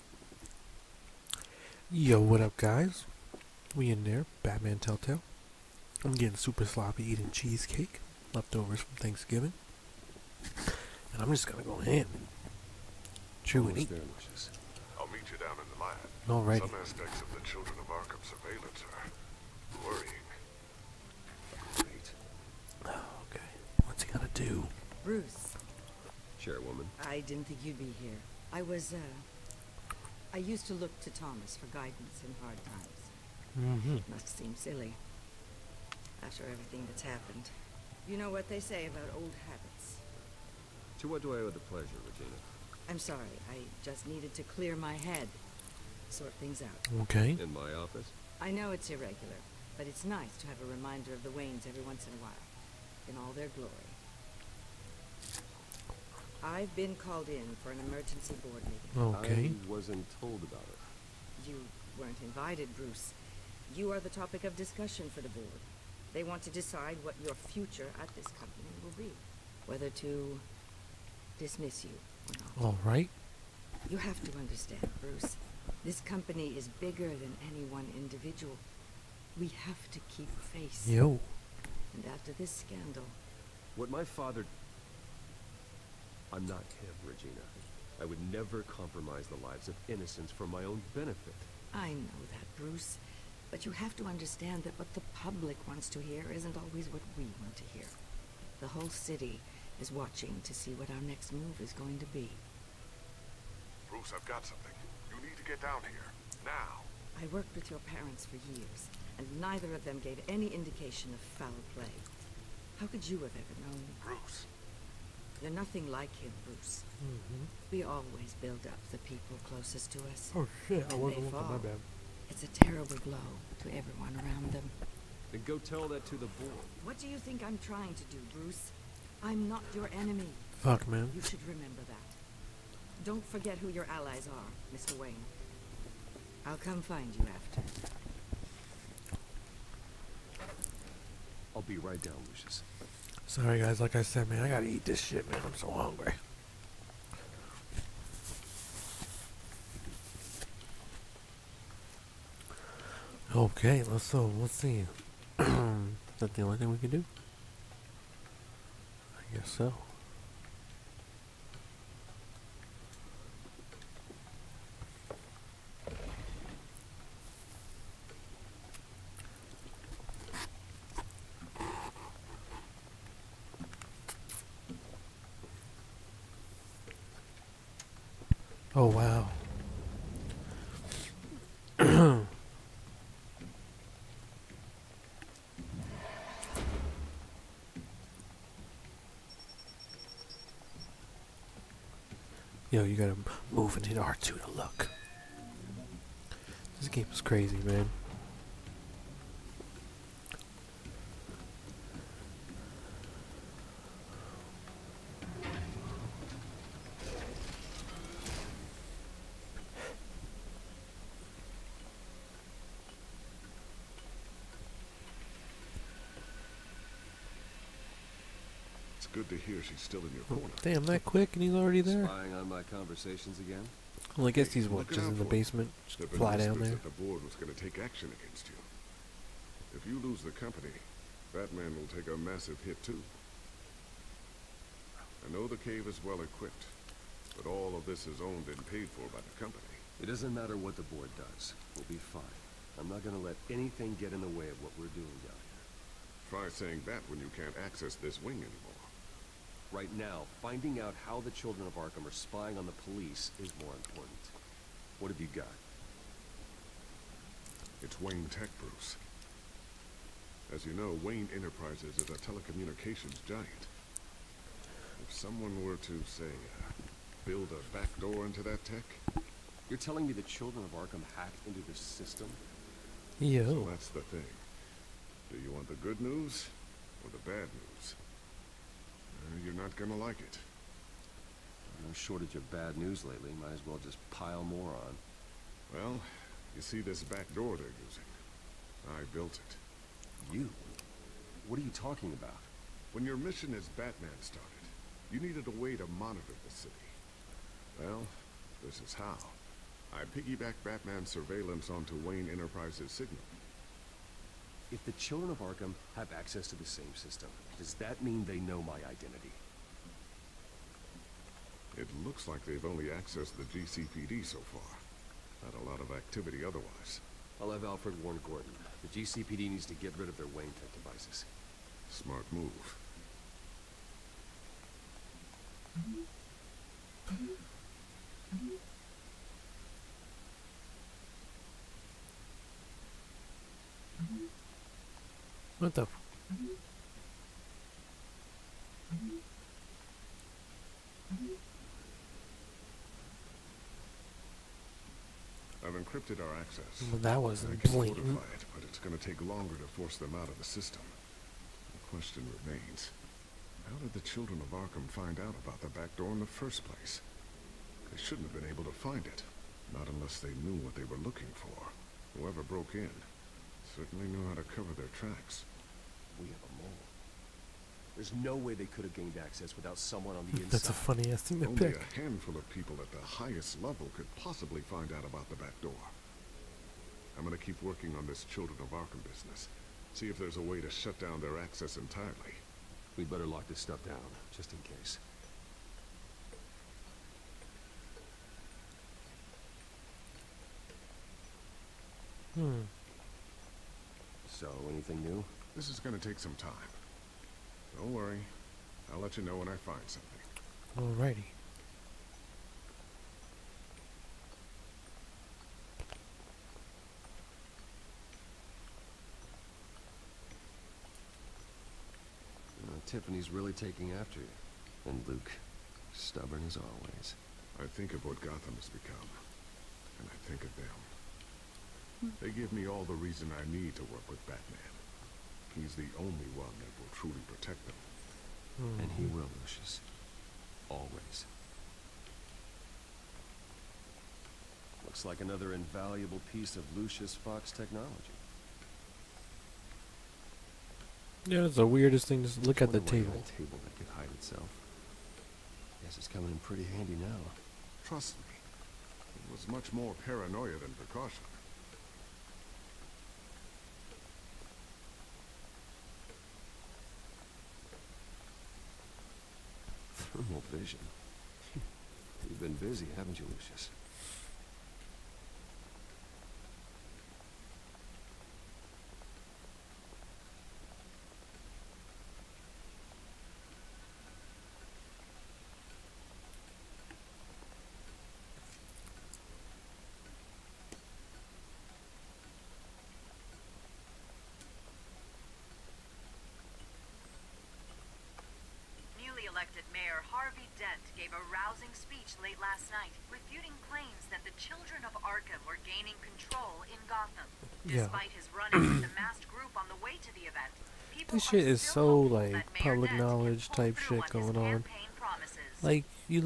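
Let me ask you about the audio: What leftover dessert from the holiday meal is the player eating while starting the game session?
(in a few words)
cheesecake.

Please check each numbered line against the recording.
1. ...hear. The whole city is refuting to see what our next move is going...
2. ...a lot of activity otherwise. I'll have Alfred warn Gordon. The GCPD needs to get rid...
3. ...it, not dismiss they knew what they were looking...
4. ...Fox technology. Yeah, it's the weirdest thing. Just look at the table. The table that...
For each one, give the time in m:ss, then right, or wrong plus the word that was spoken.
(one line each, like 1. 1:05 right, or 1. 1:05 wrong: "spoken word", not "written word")
1. 1:37 wrong: "watching", not "refuting"
2. 5:15 right
3. 5:59 wrong: "unless", not "dismiss"
4. 7:17 right.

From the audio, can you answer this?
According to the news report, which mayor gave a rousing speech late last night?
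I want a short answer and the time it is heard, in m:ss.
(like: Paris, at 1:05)
Harvey Dent, at 8:10.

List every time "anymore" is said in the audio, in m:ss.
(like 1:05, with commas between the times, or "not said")
4:08.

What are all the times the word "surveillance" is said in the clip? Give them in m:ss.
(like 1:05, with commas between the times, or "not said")
0:18, 5:01.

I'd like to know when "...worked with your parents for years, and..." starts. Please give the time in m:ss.
1:47.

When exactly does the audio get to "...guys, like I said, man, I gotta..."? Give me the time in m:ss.
2:23.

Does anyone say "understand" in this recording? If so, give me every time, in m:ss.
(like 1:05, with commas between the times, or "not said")
1:14, 1:34.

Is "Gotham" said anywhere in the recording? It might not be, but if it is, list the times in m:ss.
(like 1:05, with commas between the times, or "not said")
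6:58, 8:16.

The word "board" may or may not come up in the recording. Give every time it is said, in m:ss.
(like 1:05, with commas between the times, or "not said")
0:58, 1:05, 2:06, 3:47, 4:00.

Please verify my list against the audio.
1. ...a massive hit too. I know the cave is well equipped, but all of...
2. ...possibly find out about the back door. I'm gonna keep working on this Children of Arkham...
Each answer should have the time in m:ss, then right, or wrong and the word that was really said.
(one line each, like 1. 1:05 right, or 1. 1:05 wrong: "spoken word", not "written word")
1. 3:52 right
2. 6:14 right.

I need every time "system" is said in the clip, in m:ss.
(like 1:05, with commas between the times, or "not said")
4:31, 5:06, 5:50.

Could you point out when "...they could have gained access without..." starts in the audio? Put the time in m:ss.
6:08.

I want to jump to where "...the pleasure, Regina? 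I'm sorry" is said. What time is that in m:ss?
0:41.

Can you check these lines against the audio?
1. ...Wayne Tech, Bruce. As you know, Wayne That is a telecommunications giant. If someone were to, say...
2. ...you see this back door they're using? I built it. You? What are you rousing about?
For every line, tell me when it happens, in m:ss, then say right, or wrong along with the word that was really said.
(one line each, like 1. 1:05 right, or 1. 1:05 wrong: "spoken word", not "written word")
1. 4:17 wrong: "Enterprises", not "That"
2. 4:46 wrong: "talking", not "rousing".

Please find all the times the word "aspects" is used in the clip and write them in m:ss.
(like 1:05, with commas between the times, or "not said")
0:16.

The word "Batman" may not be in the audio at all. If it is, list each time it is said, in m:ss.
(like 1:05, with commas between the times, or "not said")
0:04, 4:53, 5:00, 7:04.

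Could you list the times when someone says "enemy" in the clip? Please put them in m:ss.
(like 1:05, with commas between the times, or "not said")
2:09.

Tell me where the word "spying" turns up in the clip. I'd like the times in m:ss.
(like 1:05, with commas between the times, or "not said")
3:42, 4:12.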